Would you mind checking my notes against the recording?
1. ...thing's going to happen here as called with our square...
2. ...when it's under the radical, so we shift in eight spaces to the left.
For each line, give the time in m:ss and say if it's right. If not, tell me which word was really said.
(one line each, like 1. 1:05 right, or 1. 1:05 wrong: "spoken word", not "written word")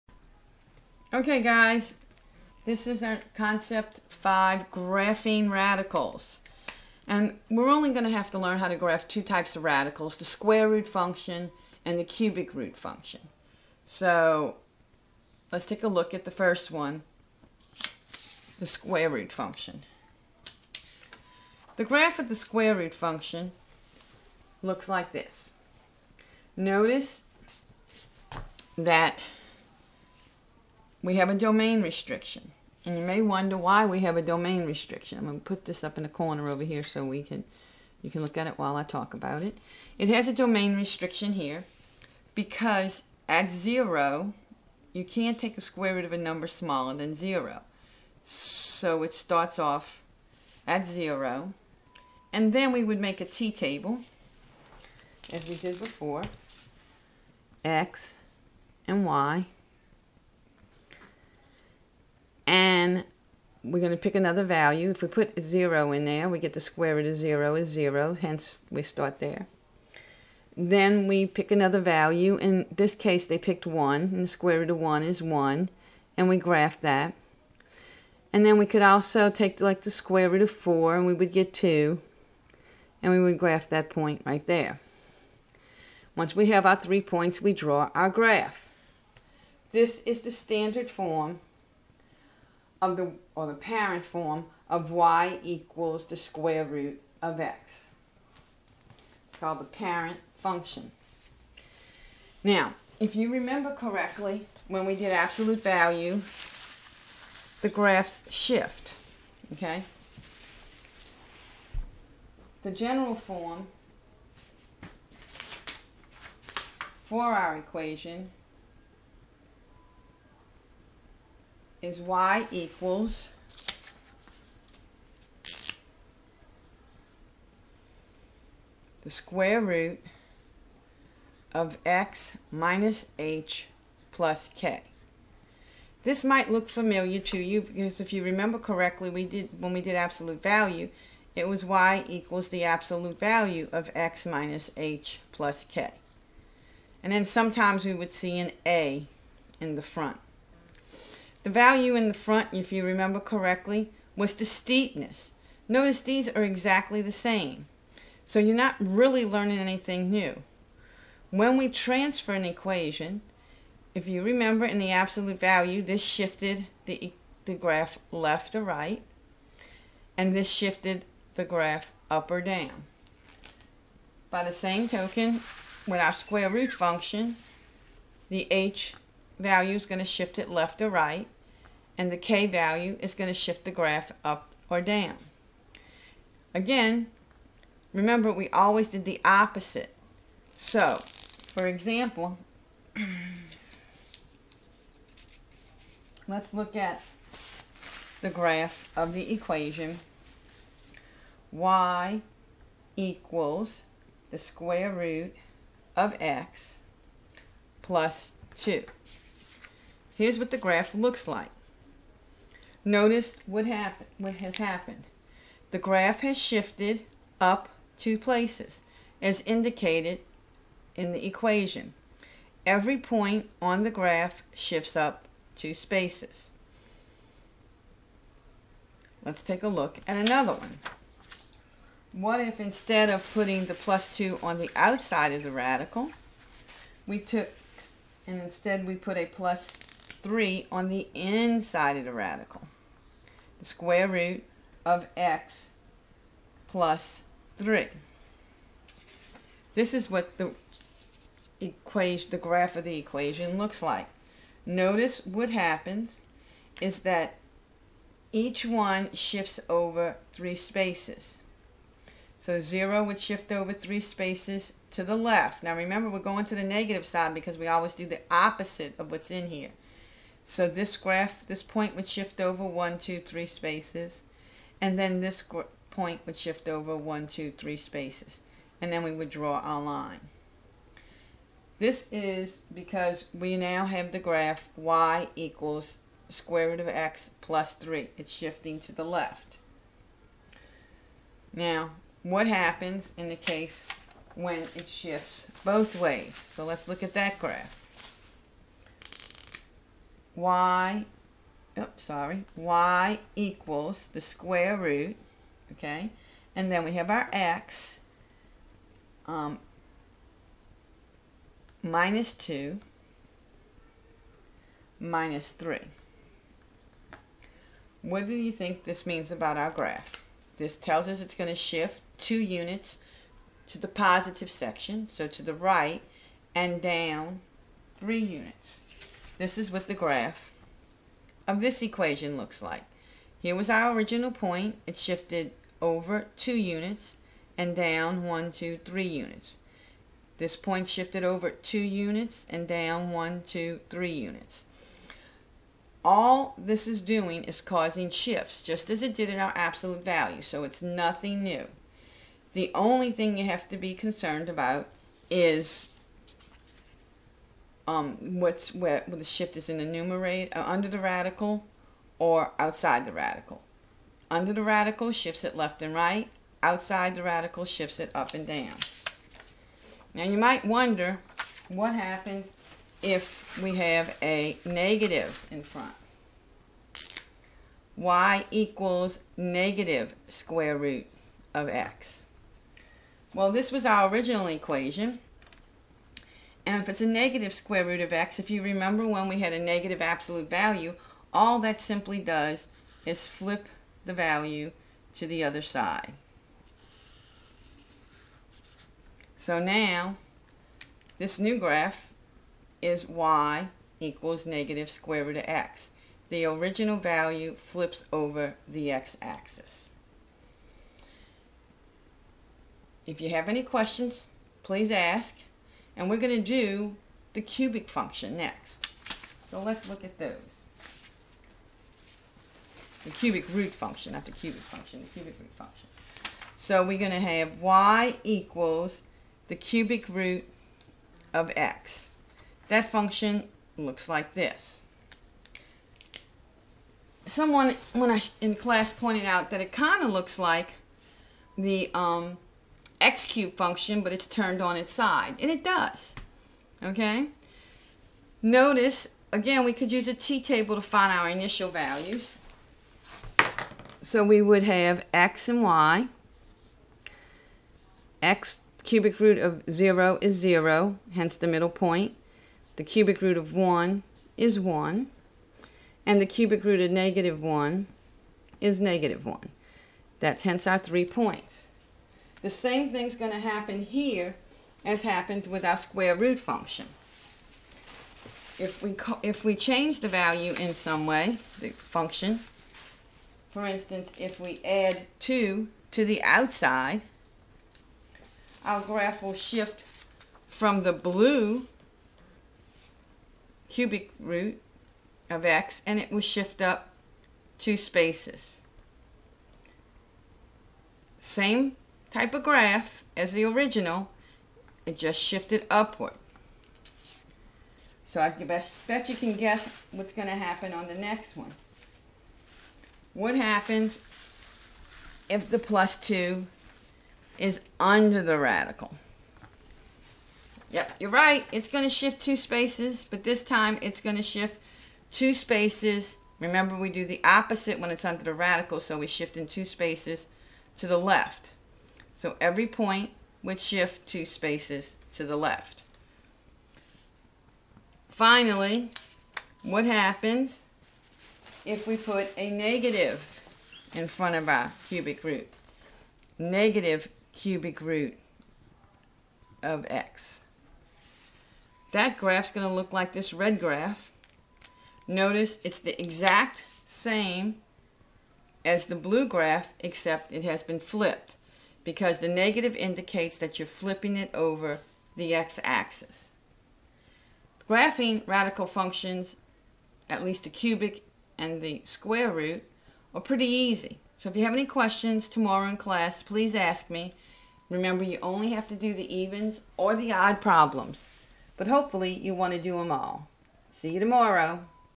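1. 7:52 wrong: "happened", not "called"
2. 8:47 wrong: "two", not "eight".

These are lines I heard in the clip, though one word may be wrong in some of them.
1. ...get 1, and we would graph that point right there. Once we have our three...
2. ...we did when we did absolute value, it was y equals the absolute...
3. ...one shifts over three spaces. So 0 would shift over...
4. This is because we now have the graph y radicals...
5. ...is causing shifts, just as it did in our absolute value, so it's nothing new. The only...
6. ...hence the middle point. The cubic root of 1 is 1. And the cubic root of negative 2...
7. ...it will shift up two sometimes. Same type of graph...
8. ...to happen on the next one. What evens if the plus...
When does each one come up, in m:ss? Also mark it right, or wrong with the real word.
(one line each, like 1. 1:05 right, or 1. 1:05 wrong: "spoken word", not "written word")
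1. 1:21 wrong: "2", not "1"
2. 2:19 right
3. 4:18 right
4. 4:41 wrong: "equals", not "radicals"
5. 5:47 right
6. 7:41 wrong: "1", not "2"
7. 8:15 wrong: "spaces", not "sometimes"
8. 8:30 wrong: "happens", not "evens".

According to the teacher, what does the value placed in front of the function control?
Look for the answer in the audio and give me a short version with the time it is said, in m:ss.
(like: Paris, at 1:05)
steepness, at 2:34.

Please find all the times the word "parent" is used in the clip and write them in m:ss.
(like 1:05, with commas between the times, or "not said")
1:33, 1:39.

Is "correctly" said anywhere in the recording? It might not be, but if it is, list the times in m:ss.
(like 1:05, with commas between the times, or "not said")
1:43, 2:18, 2:33.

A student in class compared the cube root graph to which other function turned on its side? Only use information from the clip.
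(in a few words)
x cube function.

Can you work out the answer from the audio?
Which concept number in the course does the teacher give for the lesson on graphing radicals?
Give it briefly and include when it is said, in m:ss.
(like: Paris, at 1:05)
5, at 0:04.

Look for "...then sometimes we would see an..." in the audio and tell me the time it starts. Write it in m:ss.
2:27.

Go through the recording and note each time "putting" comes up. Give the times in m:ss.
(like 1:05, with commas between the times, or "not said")
3:53.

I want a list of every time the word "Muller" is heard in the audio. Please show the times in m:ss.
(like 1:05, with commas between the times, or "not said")
not said.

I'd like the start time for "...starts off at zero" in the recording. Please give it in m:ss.
0:49.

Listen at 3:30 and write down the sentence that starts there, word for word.
Here's what the graph looks like.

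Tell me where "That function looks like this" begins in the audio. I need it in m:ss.
7:12.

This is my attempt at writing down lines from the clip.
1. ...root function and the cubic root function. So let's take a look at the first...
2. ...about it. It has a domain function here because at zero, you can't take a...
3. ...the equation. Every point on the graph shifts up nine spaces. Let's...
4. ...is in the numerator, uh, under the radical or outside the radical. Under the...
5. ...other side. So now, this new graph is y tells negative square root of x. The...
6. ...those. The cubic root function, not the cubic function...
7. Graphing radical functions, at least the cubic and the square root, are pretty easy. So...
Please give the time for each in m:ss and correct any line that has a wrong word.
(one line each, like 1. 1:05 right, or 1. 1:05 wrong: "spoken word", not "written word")
1. 0:10 right
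2. 0:39 wrong: "restriction", not "function"
3. 3:41 wrong: "two", not "nine"
4. 5:59 right
5. 6:35 wrong: "equals", not "tells"
6. 7:00 right
7. 9:27 right.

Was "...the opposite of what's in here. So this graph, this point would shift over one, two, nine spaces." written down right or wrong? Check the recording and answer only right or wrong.
wrong.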